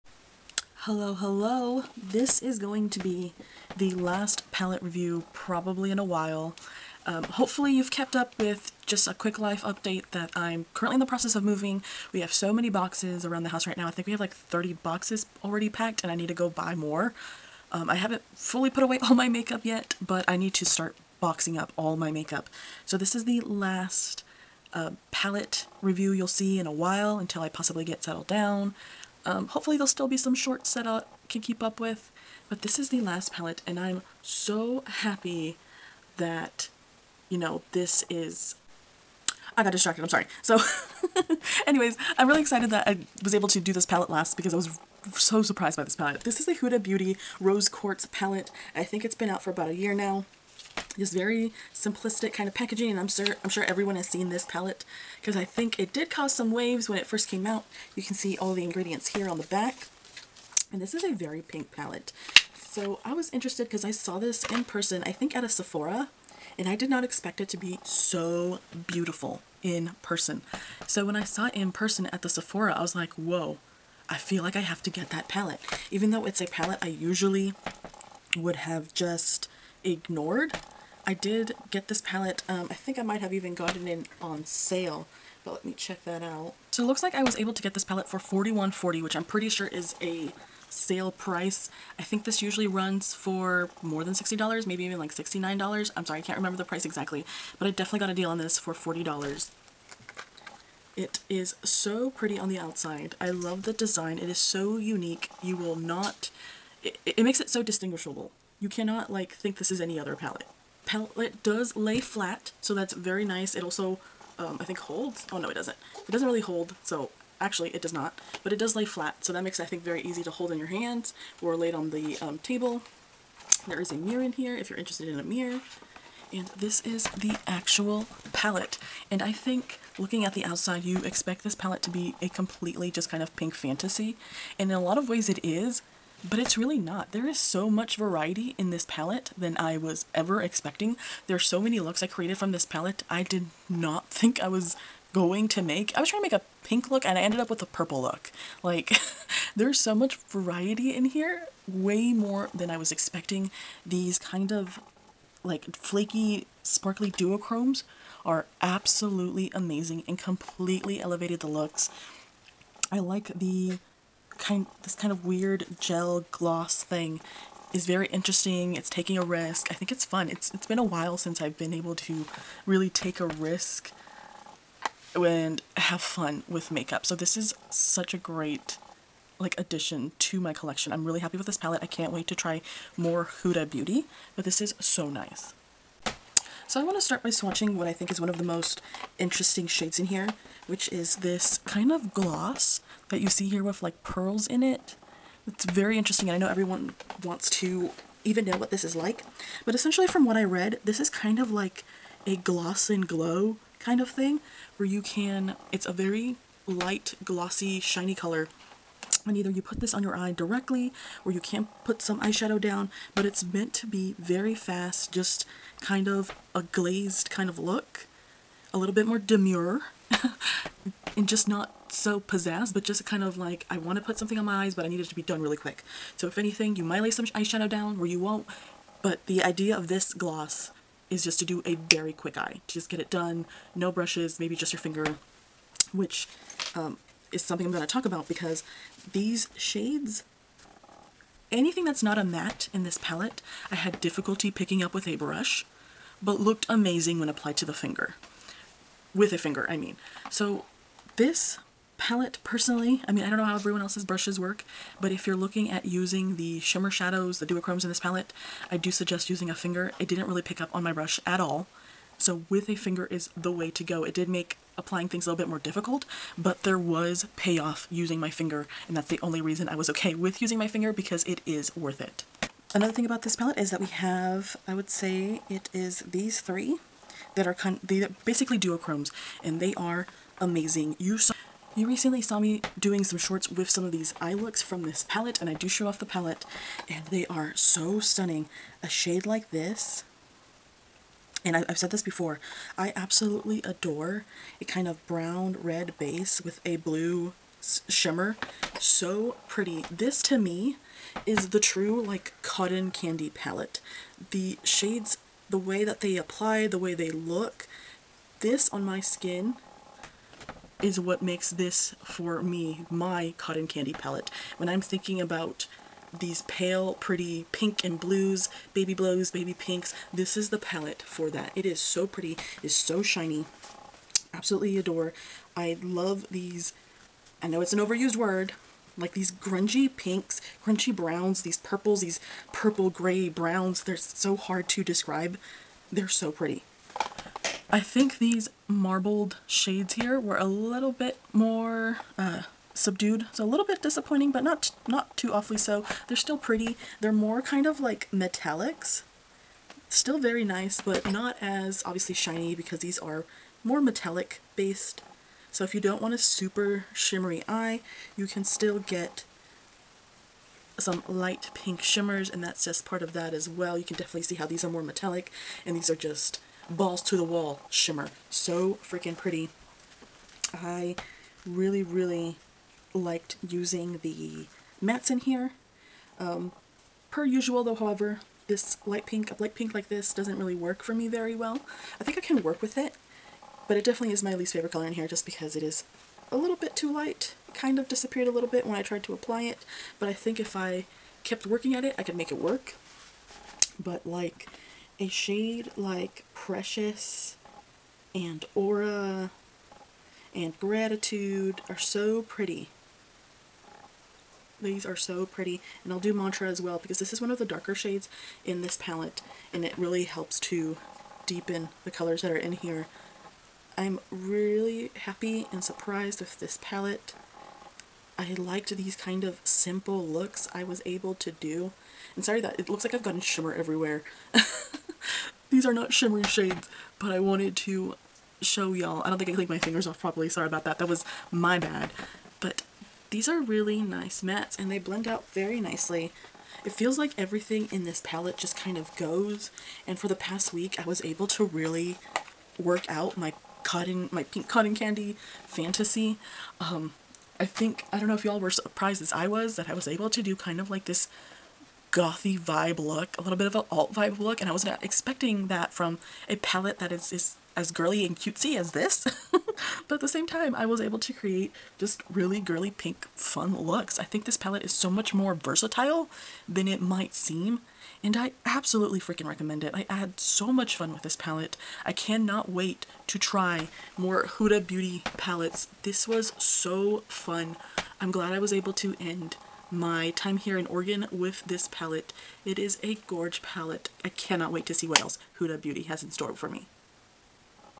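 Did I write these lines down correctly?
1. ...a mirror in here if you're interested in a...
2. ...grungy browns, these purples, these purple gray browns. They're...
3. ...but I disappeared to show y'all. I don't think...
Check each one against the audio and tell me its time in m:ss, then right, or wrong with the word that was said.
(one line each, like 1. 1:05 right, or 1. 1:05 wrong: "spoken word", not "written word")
1. 2:03 right
2. 5:30 right
3. 7:06 wrong: "wanted", not "disappeared".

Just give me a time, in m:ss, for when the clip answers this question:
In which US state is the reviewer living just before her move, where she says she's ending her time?
8:00.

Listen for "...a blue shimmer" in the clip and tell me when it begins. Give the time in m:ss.
4:56.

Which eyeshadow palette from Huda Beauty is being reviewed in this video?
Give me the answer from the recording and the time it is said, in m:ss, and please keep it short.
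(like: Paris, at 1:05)
Rose Quartz, at 0:47.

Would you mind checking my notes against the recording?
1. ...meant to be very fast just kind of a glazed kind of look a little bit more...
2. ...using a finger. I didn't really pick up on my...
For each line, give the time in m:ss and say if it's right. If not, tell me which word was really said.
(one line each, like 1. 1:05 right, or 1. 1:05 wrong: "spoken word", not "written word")
1. 3:33 right
2. 4:19 right.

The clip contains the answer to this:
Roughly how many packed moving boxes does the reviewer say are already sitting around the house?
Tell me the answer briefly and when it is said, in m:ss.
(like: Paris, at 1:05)
30, at 0:14.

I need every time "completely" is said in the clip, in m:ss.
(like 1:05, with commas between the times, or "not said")
2:12, 2:40.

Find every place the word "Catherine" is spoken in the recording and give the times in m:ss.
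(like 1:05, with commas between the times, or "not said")
not said.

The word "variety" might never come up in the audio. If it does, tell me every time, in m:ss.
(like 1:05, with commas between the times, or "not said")
2:17, 2:30.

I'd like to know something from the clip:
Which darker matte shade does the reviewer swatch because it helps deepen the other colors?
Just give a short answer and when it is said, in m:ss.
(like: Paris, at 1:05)
Mantra, at 6:46.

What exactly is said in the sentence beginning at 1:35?
I'm sorry, I can't remember the price exactly, but I definitely got a deal on this for $40.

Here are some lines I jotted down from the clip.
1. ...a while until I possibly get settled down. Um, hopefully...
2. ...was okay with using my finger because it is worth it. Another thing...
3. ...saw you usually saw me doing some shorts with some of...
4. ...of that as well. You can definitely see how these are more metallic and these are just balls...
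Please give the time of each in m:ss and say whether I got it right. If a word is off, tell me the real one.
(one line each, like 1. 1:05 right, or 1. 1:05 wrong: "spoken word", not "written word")
1. 0:26 right
2. 4:29 right
3. 4:41 wrong: "recently", not "usually"
4. 6:03 right.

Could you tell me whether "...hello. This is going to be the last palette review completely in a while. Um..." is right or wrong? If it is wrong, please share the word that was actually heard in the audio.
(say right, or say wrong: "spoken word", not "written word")
wrong: "probably", not "completely".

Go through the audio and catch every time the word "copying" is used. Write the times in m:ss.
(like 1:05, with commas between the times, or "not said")
not said.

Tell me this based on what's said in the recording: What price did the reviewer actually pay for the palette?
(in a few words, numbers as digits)
$41.40.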